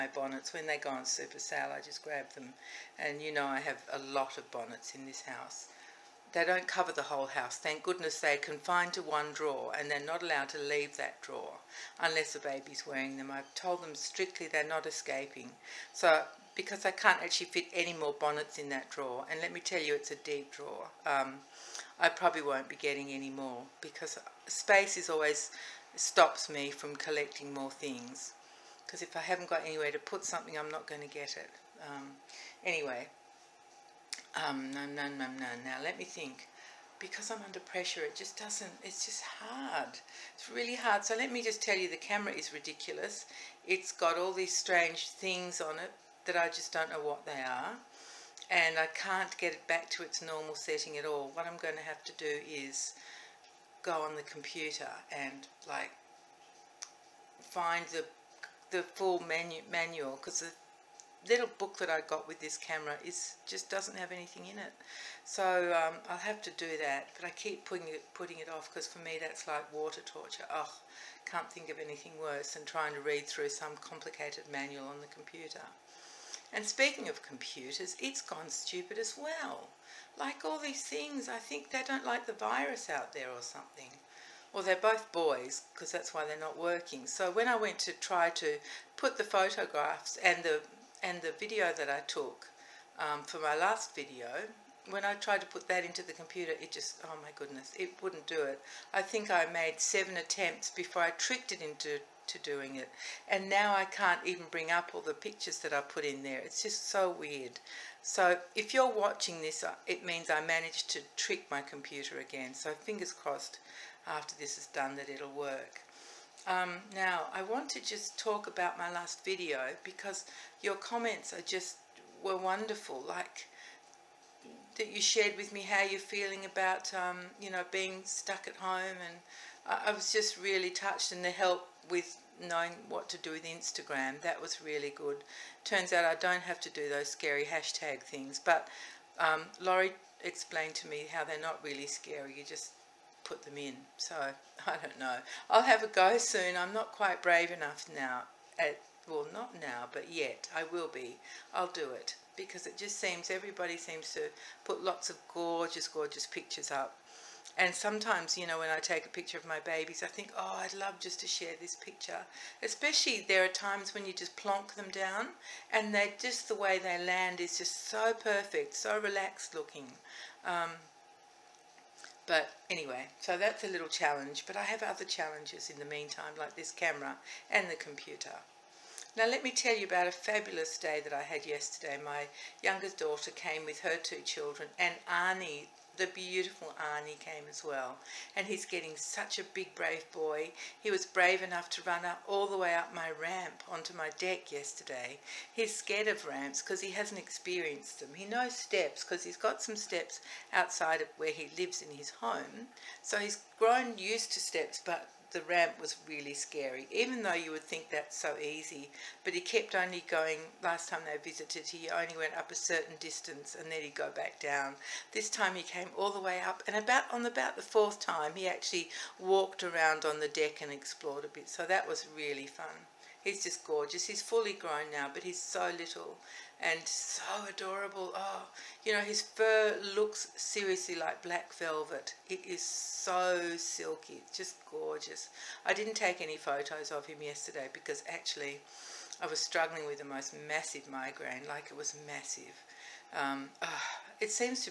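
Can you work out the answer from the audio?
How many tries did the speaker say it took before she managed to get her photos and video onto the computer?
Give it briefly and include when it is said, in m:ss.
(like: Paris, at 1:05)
7, at 1:39.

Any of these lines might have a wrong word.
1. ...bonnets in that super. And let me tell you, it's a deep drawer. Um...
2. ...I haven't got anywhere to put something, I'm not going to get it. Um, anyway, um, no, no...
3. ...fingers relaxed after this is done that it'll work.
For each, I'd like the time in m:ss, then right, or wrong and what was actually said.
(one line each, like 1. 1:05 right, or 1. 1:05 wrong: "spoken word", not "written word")
1. 0:18 wrong: "drawer", not "super"
2. 0:29 right
3. 1:52 wrong: "crossed", not "relaxed".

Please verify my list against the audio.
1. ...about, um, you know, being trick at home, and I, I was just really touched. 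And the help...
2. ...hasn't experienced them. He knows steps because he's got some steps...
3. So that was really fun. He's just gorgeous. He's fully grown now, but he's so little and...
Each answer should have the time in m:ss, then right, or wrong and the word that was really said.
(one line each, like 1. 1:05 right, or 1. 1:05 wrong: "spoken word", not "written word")
1. 2:06 wrong: "stuck", not "trick"
2. 3:16 right
3. 3:41 right.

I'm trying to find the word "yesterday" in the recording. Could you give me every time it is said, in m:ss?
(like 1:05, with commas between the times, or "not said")
3:01, 3:14, 3:57.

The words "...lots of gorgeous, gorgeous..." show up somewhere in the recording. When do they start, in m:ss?
2:34.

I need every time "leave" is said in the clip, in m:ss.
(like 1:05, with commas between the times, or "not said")
0:10.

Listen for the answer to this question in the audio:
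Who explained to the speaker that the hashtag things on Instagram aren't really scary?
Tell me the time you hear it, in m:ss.
2:19.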